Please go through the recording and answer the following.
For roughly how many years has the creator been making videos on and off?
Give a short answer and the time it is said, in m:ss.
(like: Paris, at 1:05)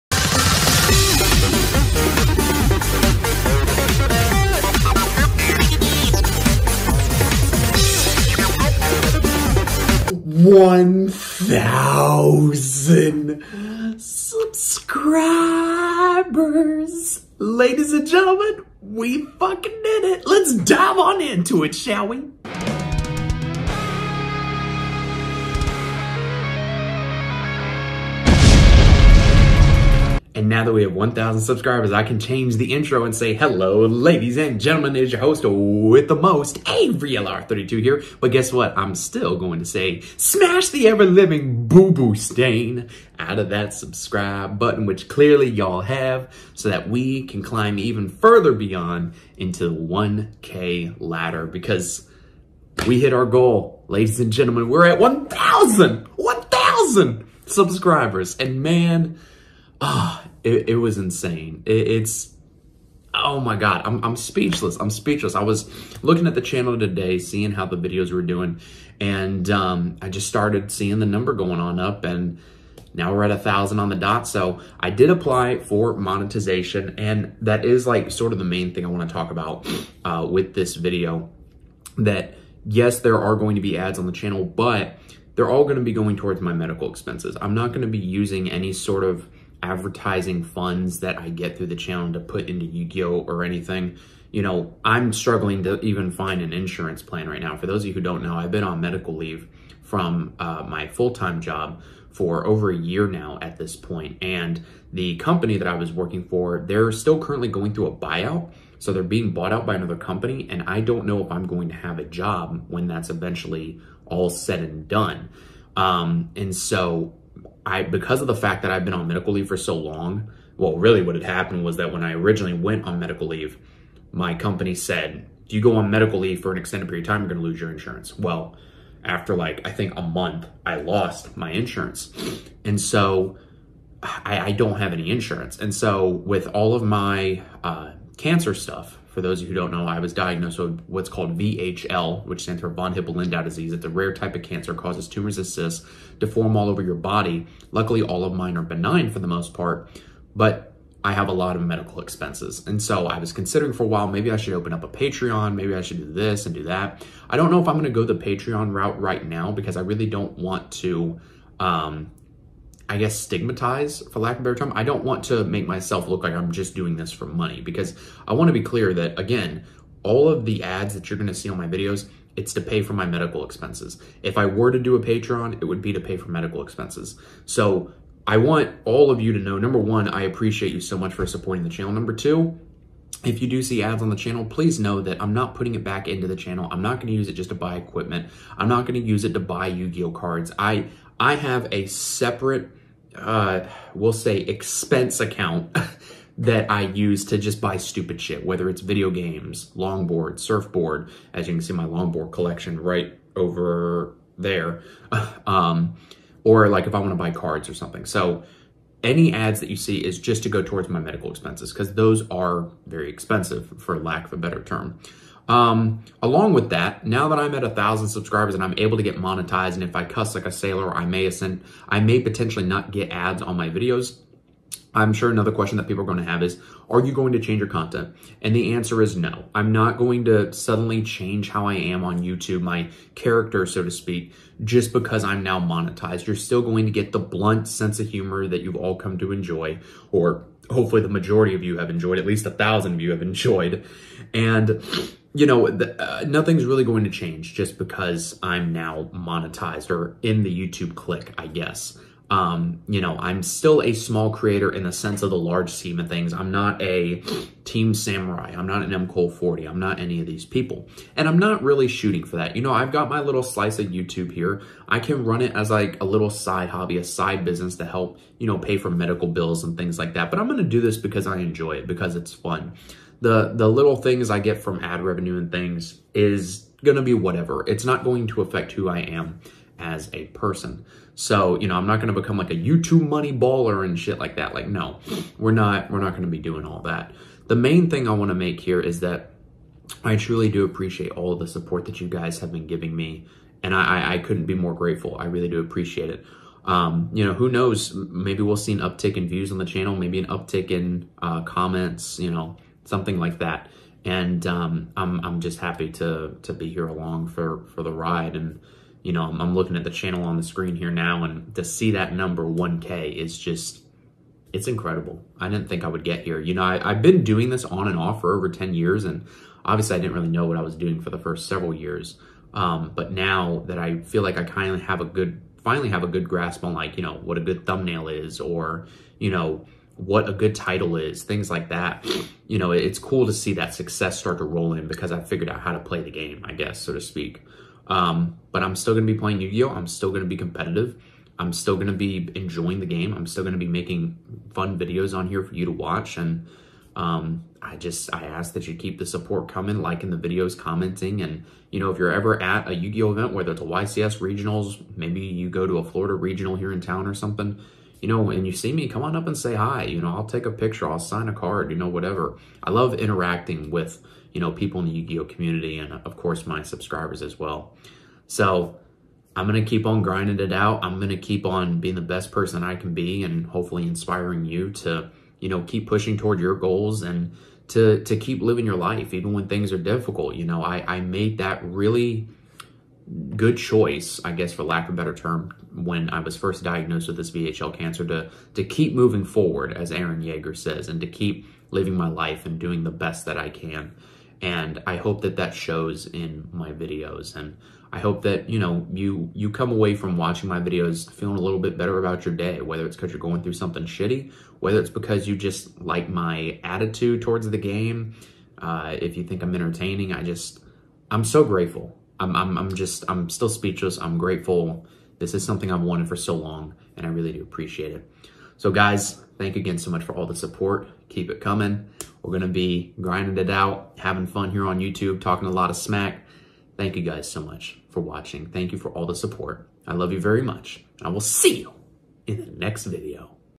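Over 10 years, at 5:18.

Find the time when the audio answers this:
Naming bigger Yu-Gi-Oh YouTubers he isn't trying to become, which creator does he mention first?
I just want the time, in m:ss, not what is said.
4:17.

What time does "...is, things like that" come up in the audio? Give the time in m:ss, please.
5:30.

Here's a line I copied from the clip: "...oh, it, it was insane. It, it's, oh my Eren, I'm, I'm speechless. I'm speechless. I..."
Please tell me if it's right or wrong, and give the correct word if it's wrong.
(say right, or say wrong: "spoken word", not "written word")
wrong: "God", not "Eren".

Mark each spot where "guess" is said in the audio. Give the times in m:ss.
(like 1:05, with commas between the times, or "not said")
0:38, 2:42, 4:11, 5:36, 6:24.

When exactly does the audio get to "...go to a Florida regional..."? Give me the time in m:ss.
5:55.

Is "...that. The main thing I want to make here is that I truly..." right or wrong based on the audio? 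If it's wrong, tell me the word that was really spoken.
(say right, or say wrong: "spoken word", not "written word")
right.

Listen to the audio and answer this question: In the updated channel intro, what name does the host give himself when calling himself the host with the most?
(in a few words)
Avery LR32.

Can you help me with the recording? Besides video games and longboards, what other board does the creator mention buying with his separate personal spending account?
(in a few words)
Surfboard.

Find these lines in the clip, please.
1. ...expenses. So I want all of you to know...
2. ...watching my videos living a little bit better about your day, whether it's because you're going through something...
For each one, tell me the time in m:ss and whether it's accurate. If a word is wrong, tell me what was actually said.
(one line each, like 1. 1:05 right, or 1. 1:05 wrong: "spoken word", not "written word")
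1. 2:56 right
2. 6:40 wrong: "feeling", not "living".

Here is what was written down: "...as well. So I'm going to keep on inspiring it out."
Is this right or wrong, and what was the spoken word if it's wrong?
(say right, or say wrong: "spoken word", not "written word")
wrong: "grinding", not "inspiring".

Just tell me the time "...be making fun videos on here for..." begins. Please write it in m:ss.
5:43.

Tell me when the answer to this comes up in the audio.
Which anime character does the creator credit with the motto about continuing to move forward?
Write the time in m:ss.
6:29.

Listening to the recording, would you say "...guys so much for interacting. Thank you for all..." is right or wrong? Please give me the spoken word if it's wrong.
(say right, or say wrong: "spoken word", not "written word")
wrong: "watching", not "interacting".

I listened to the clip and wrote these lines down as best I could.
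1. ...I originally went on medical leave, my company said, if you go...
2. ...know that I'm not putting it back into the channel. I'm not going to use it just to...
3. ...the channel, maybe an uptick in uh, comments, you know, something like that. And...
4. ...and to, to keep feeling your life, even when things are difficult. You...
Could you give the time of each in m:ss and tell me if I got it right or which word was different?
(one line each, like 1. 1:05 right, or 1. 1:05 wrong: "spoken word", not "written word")
1. 2:02 right
2. 3:04 right
3. 4:59 right
4. 6:17 wrong: "living", not "feeling".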